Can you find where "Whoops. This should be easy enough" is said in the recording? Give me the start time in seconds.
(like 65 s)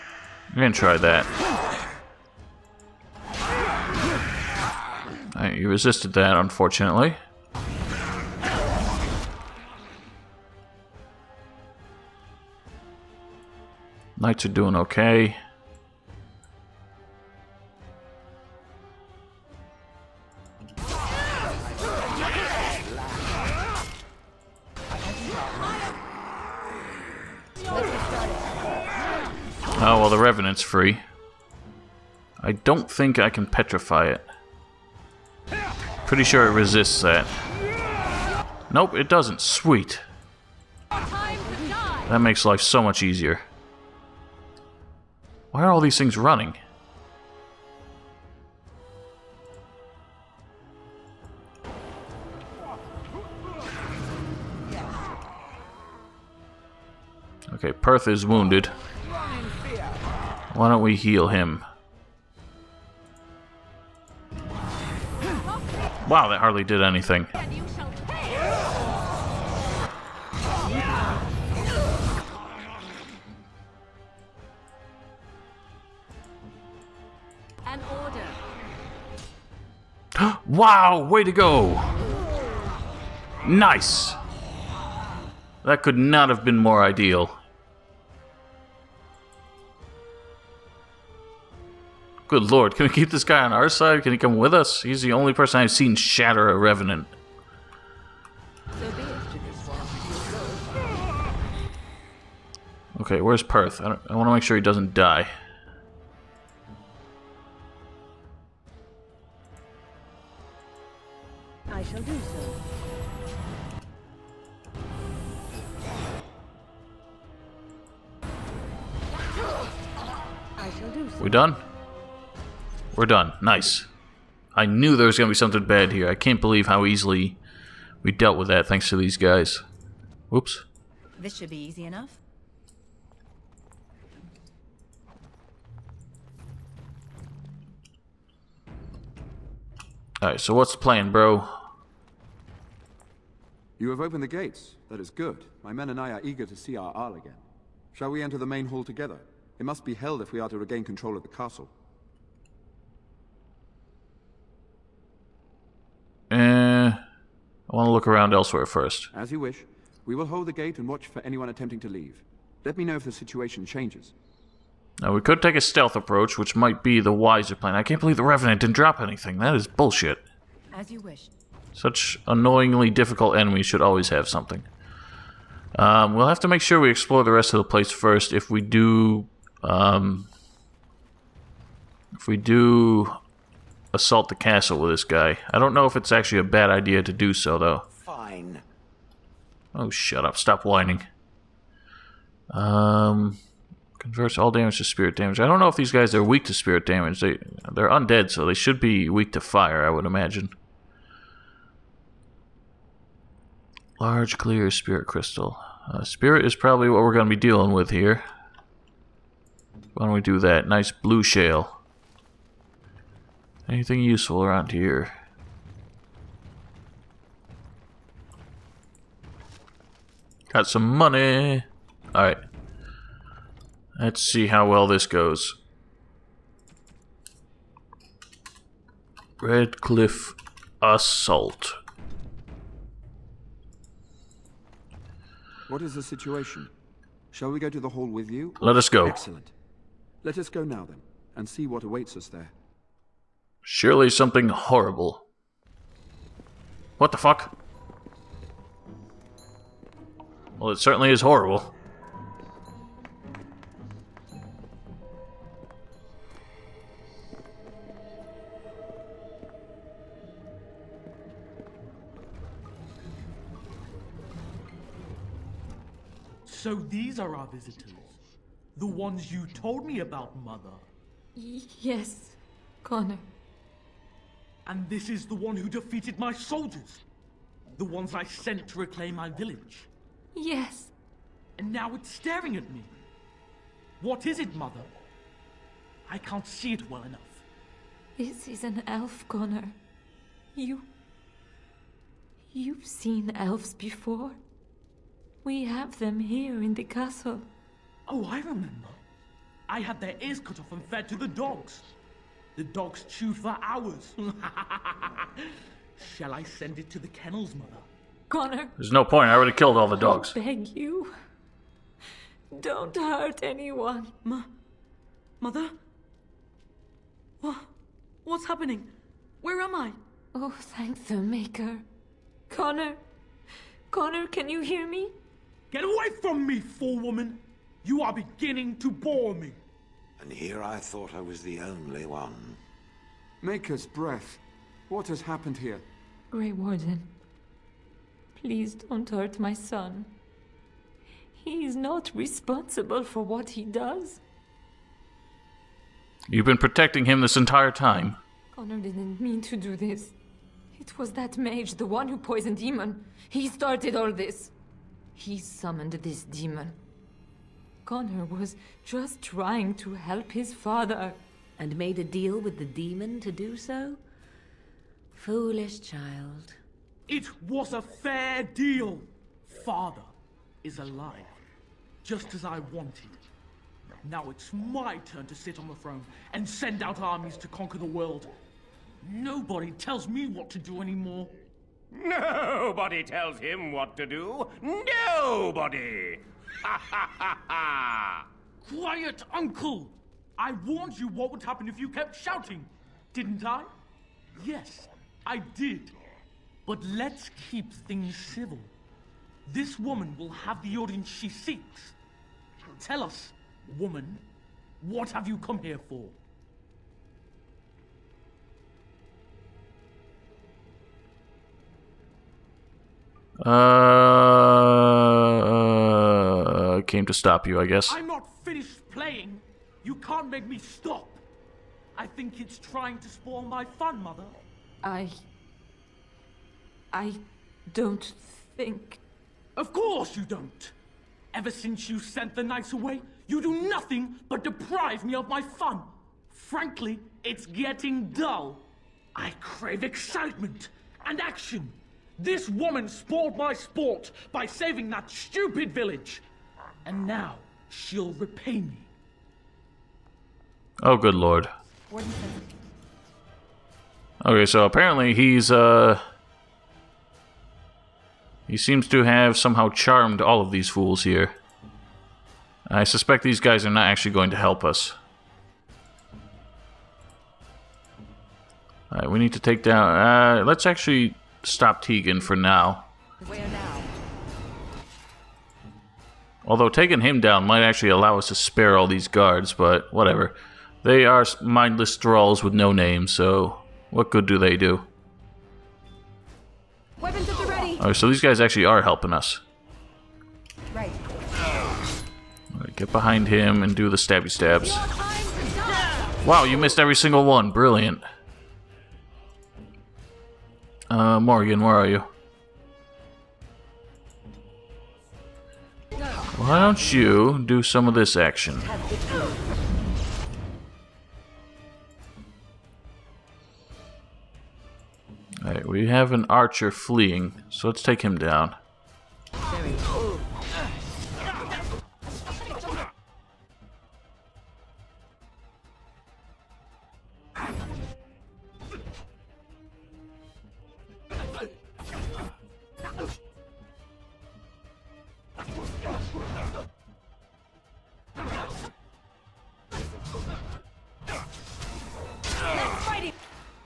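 130 s.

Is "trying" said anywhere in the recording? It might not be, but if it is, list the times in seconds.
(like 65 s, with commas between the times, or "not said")
359 s, 422 s.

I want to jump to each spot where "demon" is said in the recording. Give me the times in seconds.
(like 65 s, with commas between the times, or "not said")
356 s, 362 s.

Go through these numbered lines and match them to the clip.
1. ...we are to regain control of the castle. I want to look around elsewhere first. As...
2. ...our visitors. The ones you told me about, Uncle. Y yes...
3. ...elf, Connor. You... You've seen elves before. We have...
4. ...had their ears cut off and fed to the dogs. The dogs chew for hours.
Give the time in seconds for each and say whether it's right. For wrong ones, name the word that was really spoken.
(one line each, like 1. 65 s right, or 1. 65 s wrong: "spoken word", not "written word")
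1. 150 s right
2. 267 s wrong: "Mother", not "Uncle"
3. 288 s right
4. 299 s right.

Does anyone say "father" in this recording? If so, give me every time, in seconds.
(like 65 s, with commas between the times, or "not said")
360 s, 369 s.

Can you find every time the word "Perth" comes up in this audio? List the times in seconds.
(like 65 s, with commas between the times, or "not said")
57 s, 103 s.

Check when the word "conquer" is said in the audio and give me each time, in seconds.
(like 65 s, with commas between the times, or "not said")
377 s.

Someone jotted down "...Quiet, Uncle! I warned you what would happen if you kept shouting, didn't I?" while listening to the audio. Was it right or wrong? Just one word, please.
right.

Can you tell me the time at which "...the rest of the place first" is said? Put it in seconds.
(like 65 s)
177 s.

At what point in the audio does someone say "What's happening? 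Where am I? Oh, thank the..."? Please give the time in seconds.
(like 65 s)
318 s.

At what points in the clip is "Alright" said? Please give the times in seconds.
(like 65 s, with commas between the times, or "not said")
140 s, 222 s, 468 s, 515 s.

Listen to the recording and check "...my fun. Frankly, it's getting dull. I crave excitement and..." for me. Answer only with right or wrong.
right.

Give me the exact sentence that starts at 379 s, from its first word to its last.
Nobody tells me what to do anymore.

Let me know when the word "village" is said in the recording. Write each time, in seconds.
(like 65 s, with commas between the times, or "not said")
279 s, 445 s.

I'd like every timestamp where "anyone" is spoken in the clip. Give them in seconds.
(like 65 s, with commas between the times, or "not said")
161 s, 313 s.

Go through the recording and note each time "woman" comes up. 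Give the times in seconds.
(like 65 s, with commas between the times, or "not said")
326 s, 399 s, 403 s, 442 s.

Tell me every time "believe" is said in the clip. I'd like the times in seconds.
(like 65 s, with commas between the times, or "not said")
126 s, 167 s.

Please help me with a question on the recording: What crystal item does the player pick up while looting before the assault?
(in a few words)
Large clear spirit crystal.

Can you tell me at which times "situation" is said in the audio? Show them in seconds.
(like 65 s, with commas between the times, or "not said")
163 s, 236 s.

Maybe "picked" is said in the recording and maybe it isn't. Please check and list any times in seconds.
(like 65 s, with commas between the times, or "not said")
not said.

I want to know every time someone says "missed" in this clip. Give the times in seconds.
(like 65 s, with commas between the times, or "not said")
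496 s.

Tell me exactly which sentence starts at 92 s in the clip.
Good lord, can we keep this guy on our side?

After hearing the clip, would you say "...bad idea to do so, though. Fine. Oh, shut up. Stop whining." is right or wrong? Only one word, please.
right.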